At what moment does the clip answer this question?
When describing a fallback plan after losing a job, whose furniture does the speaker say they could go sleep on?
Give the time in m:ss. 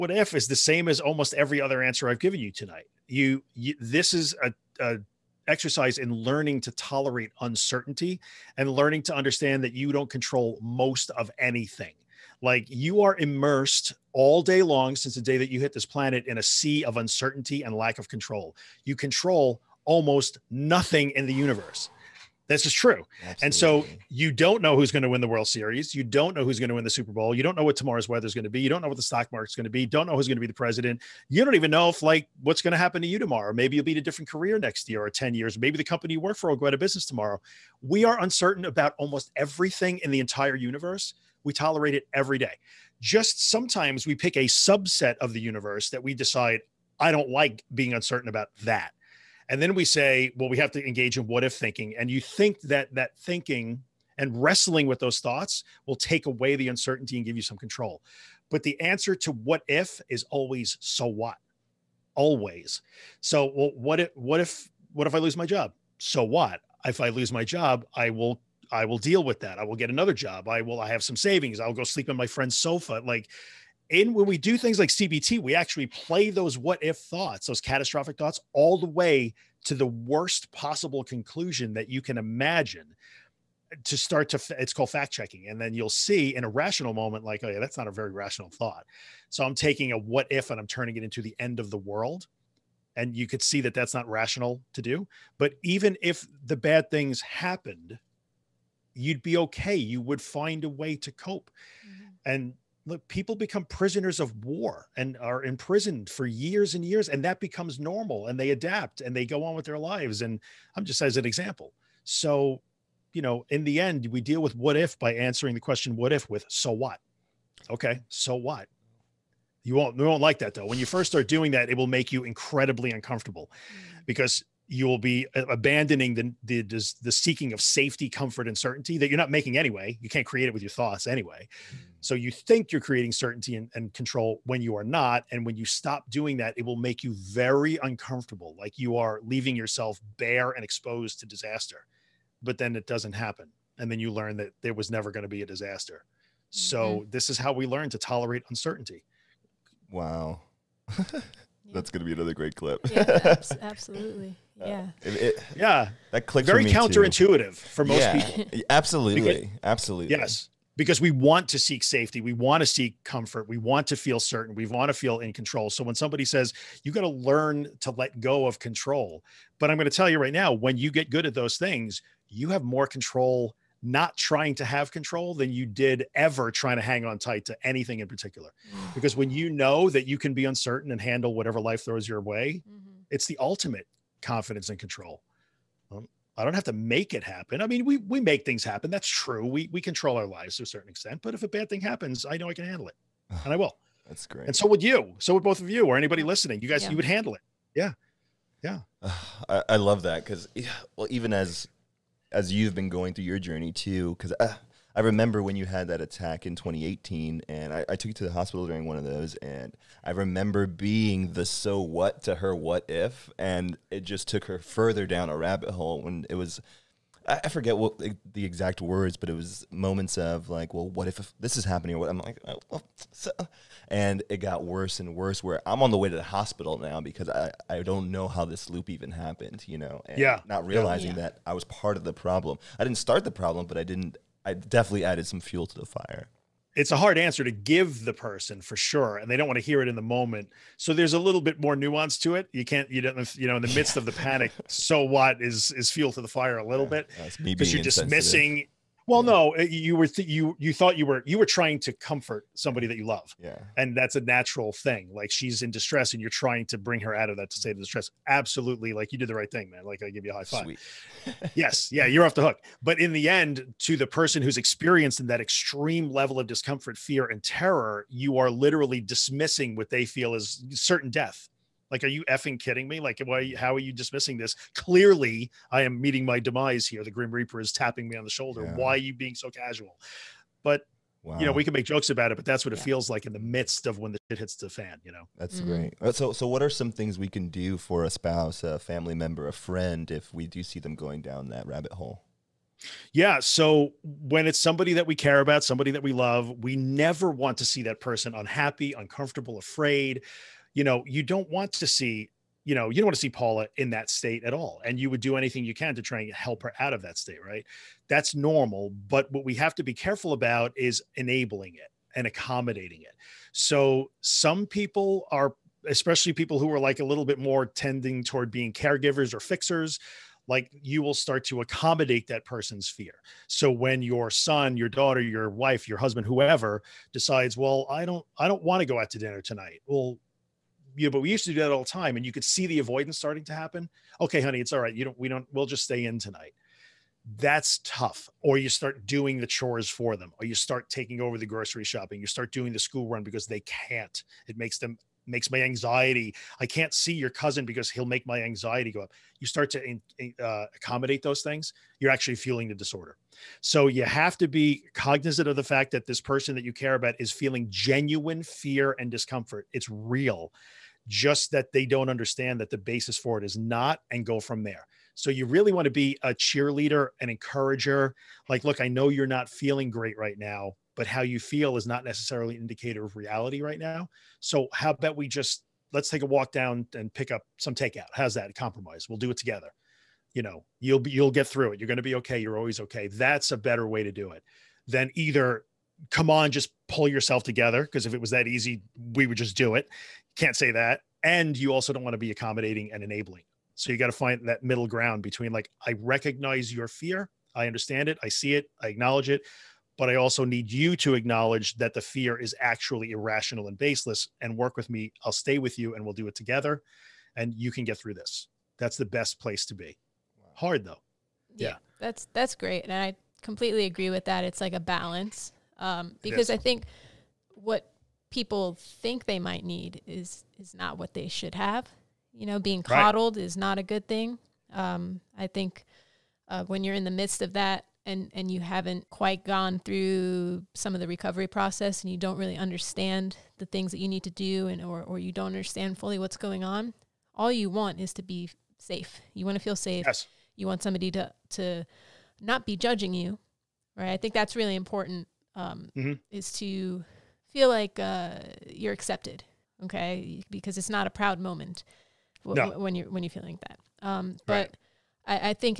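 1:12.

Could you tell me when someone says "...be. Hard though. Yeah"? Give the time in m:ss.
6:49.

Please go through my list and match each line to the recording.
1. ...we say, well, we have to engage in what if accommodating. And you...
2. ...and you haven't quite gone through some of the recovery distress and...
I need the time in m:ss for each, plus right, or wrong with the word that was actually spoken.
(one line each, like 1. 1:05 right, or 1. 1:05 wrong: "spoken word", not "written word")
1. 0:49 wrong: "thinking", not "accommodating"
2. 7:08 wrong: "process", not "distress".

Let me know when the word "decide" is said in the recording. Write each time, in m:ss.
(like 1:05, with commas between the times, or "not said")
0:46, 5:27.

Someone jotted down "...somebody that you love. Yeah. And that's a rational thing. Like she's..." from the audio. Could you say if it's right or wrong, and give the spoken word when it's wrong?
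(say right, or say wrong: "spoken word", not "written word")
wrong: "natural", not "rational".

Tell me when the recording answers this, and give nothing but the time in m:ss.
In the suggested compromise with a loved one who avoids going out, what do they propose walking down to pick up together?
6:17.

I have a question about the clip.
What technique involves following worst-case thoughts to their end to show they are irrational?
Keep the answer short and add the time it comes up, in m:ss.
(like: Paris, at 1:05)
Fact checking, at 1:24.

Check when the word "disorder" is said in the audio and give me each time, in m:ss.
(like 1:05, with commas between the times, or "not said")
5:52.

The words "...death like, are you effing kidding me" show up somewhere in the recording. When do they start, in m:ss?
4:31.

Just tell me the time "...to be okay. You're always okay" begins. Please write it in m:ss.
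6:21.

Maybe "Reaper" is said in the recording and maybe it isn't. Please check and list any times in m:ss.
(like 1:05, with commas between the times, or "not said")
4:37.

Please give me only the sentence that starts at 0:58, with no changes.
But the answer to what if is always so what?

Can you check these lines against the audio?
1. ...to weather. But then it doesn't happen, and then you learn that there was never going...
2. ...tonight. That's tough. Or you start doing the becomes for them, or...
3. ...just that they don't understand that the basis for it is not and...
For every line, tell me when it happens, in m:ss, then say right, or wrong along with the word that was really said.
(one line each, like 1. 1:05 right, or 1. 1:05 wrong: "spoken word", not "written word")
1. 2:21 wrong: "disaster", not "weather"
2. 5:36 wrong: "chores", not "becomes"
3. 6:01 right.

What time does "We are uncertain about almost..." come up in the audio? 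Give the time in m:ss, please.
0:37.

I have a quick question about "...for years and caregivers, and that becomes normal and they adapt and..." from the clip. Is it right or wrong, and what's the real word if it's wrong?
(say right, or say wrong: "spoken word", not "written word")
wrong: "years", not "caregivers".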